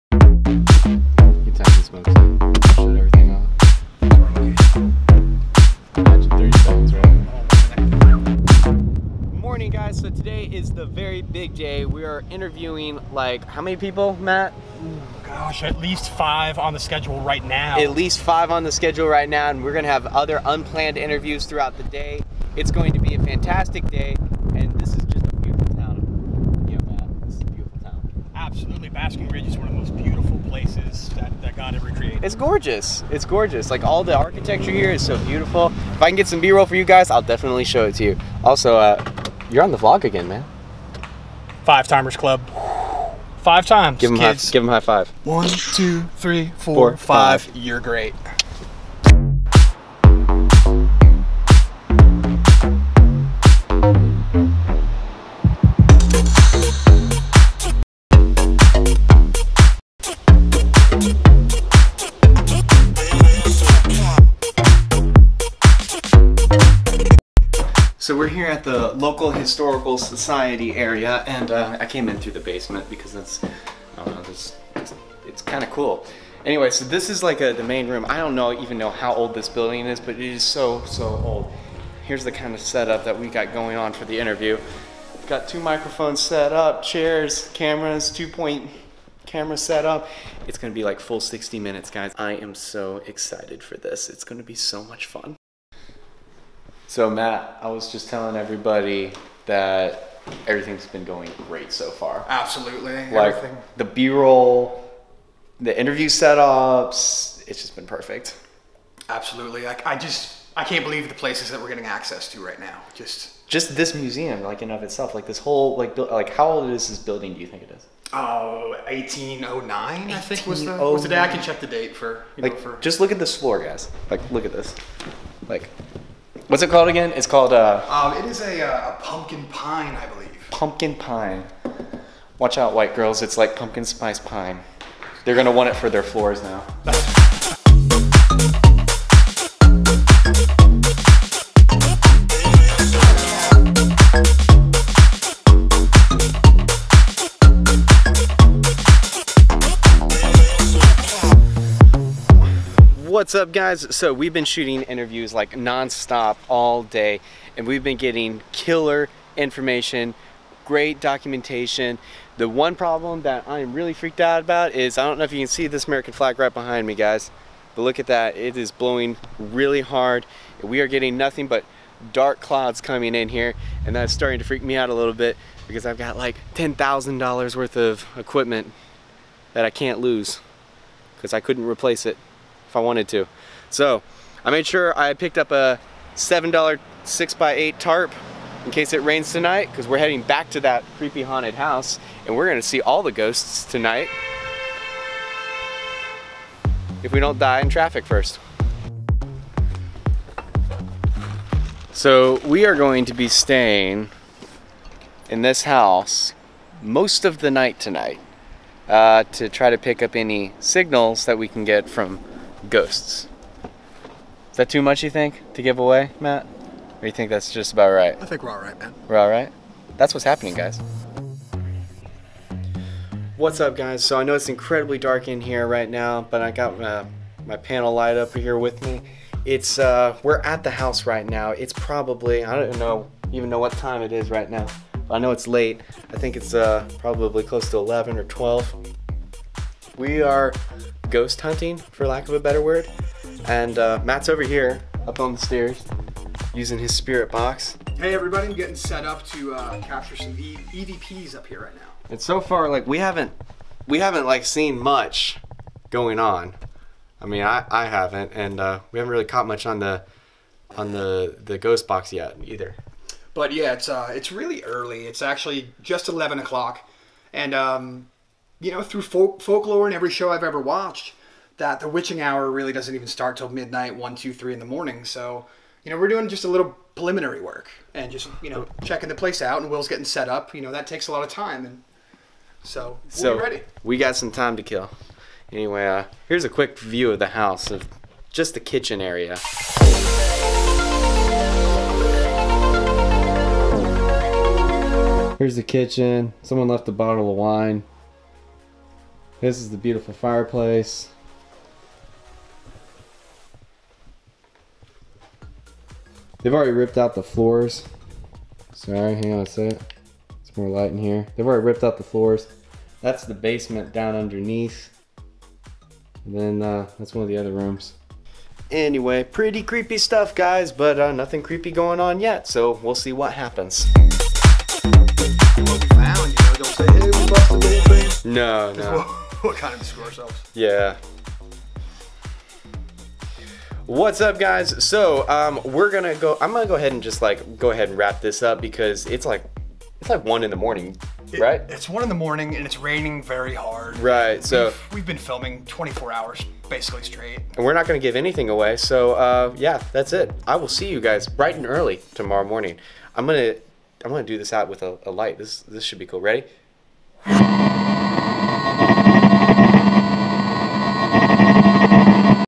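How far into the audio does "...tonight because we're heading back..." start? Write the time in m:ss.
3:09.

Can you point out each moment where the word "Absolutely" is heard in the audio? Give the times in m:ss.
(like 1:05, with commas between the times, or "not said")
0:28, 1:42, 1:49.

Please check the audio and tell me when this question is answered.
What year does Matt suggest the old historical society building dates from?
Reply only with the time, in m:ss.
1:58.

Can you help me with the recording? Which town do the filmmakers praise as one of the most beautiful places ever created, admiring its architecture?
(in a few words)
Basking Ridge.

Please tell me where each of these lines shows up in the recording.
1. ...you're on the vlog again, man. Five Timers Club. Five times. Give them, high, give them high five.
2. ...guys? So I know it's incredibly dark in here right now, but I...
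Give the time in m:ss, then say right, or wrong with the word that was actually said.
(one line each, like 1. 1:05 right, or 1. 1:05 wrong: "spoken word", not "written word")
1. 0:39 right
2. 3:43 right.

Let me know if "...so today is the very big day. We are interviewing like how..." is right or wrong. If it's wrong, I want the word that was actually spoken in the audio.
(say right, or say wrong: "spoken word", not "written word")
right.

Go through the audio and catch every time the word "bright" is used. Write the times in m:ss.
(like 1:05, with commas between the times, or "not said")
5:51.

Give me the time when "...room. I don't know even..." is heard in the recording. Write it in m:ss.
1:17.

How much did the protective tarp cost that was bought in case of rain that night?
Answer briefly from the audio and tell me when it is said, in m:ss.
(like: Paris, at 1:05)
$7, at 3:06.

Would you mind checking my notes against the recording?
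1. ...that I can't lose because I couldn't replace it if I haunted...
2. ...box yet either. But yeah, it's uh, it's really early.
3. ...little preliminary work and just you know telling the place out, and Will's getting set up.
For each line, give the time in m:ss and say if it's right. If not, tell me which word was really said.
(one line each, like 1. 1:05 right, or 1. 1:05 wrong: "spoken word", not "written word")
1. 2:59 wrong: "wanted", not "haunted"
2. 4:21 right
3. 4:36 wrong: "checking", not "telling".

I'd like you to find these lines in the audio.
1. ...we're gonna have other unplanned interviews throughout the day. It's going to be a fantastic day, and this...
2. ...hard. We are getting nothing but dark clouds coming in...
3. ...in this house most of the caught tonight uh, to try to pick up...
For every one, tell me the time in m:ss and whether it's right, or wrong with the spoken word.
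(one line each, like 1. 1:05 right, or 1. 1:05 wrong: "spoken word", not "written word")
1. 0:19 right
2. 2:49 right
3. 3:25 wrong: "night", not "caught".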